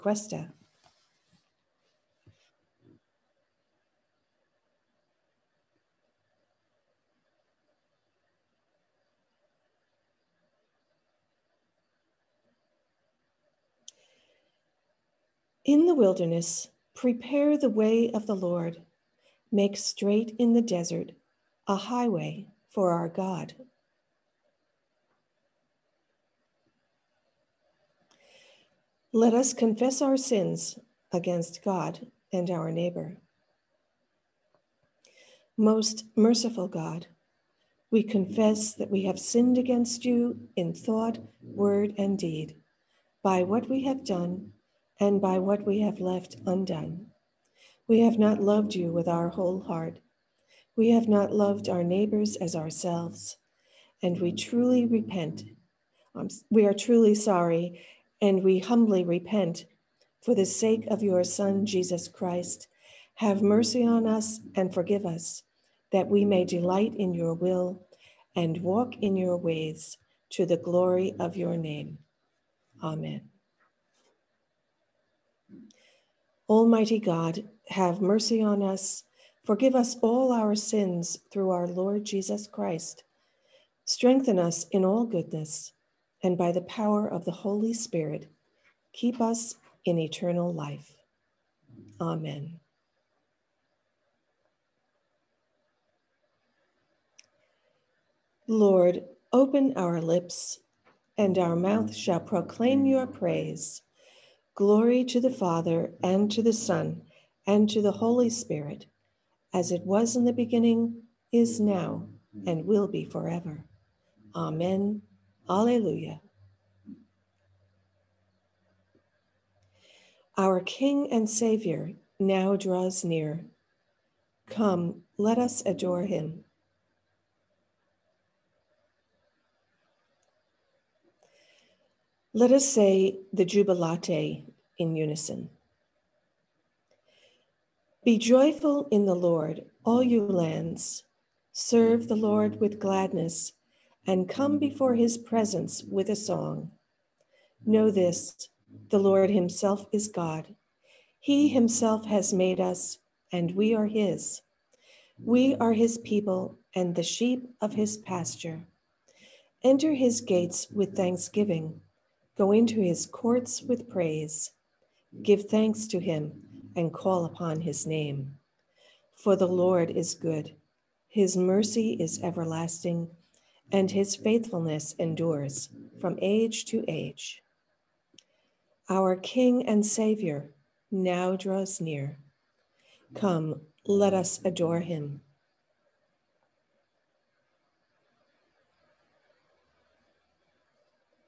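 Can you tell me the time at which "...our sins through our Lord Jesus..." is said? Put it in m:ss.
1:20.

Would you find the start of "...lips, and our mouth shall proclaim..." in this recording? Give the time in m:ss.
1:40.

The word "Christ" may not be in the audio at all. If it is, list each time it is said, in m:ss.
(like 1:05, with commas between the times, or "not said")
1:02, 1:22.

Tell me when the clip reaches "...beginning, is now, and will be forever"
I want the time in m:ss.
1:50.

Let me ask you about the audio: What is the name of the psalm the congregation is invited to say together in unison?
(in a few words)
Jubilate.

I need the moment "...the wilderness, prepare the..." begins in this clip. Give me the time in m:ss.
0:15.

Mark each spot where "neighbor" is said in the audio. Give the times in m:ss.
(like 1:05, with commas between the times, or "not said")
0:32, 0:51.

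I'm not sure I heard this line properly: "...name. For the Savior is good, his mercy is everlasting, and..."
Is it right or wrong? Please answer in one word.
wrong.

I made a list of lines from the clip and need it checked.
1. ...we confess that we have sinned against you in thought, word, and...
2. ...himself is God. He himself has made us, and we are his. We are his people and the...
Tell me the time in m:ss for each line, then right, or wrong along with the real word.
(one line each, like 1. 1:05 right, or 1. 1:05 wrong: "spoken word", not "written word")
1. 0:37 right
2. 2:29 right.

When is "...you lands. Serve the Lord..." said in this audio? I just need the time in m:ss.
2:20.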